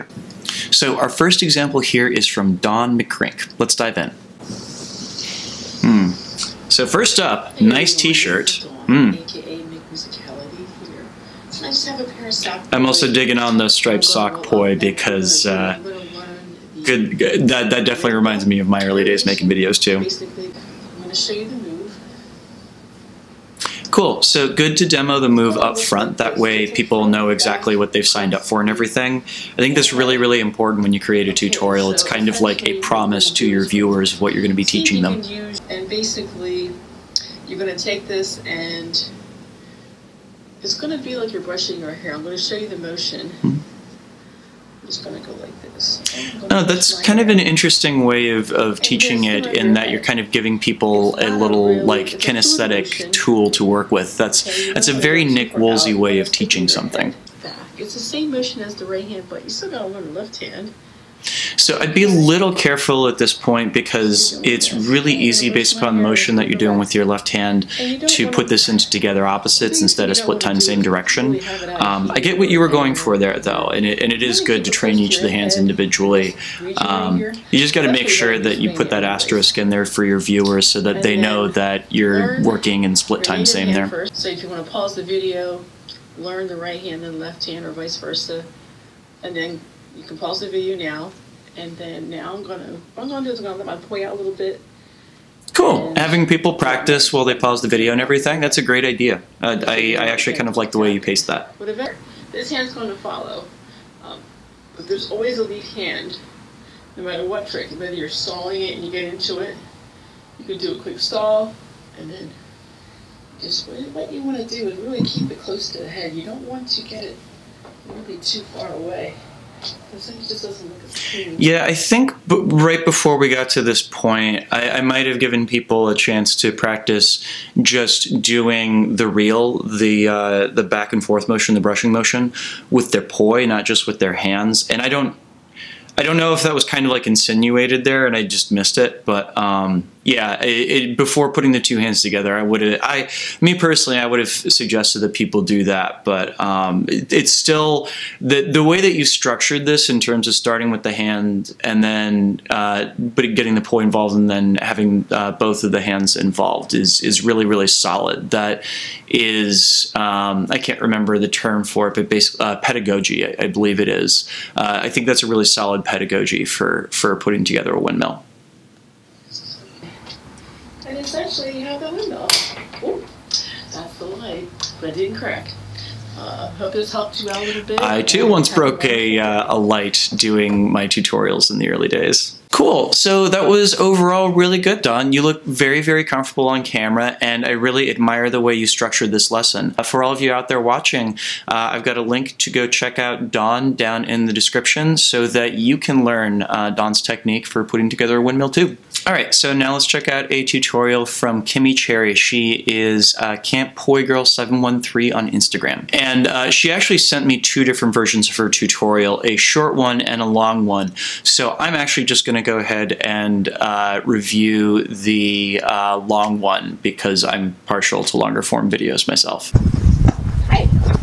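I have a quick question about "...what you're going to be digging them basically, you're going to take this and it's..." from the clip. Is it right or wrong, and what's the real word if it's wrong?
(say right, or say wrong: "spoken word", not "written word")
wrong: "teaching", not "digging".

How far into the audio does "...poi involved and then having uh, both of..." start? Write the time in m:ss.
2:33.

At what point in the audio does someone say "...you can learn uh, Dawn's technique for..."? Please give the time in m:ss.
3:15.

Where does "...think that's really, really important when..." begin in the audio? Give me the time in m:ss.
0:29.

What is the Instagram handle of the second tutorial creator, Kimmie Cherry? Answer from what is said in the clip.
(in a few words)
Camp Poi Girl 713.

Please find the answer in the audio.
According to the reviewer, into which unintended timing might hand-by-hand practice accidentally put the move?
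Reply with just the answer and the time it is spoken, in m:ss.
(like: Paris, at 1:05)
together opposites, at 1:08.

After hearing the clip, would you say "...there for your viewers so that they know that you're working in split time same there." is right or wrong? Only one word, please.
right.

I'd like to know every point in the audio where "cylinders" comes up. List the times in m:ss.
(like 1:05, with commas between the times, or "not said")
not said.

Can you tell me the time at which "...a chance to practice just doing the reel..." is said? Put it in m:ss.
2:05.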